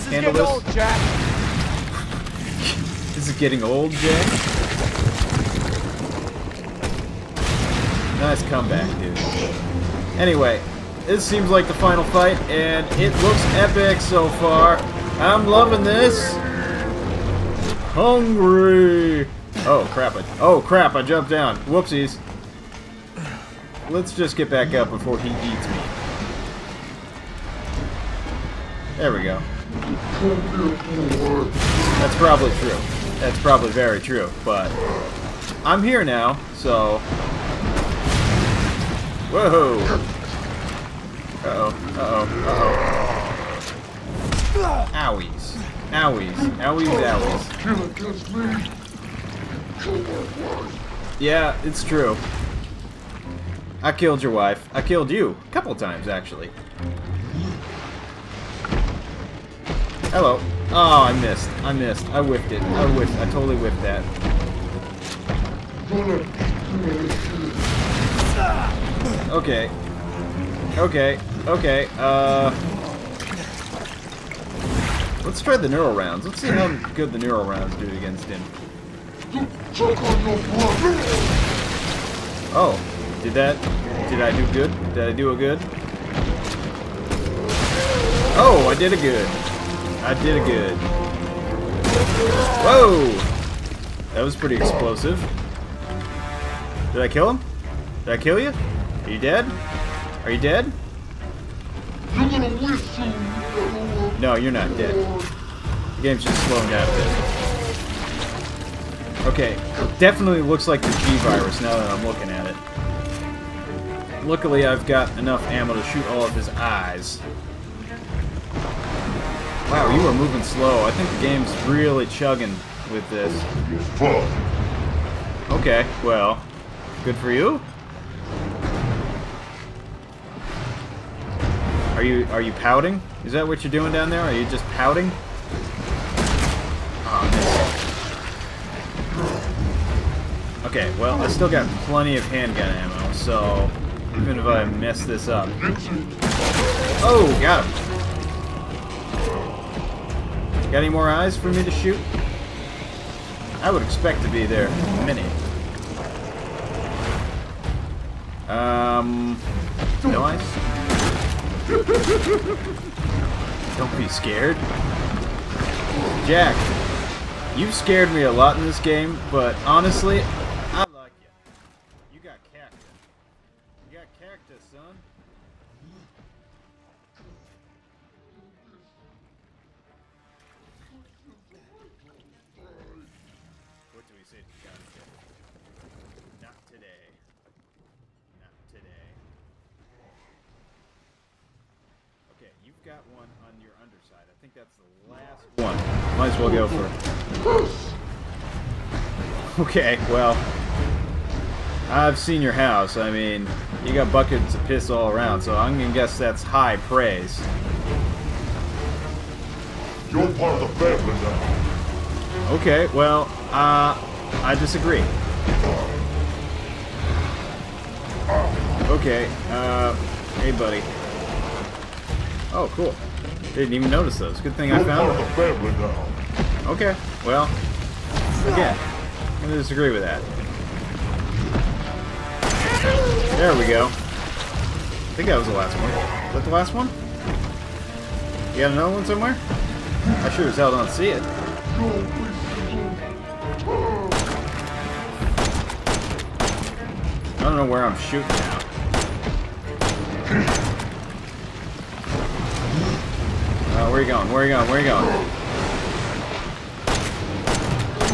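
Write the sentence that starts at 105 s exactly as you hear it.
The game's just slowing down a bit.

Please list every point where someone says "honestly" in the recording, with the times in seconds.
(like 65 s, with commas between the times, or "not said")
169 s.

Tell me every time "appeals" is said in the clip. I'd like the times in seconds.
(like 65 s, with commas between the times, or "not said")
not said.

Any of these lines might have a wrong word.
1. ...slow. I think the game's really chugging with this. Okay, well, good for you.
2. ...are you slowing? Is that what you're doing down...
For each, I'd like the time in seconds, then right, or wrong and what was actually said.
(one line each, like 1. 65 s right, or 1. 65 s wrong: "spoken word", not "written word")
1. 120 s right
2. 132 s wrong: "pouting", not "slowing".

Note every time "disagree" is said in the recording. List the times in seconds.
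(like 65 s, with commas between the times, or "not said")
214 s, 229 s.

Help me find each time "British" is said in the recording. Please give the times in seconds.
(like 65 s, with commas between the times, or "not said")
not said.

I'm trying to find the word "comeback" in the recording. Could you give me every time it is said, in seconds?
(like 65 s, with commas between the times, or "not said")
8 s.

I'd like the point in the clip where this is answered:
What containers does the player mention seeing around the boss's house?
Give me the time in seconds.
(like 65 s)
204 s.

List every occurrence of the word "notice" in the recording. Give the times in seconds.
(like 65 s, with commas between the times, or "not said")
223 s.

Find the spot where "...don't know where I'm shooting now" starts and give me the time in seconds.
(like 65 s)
247 s.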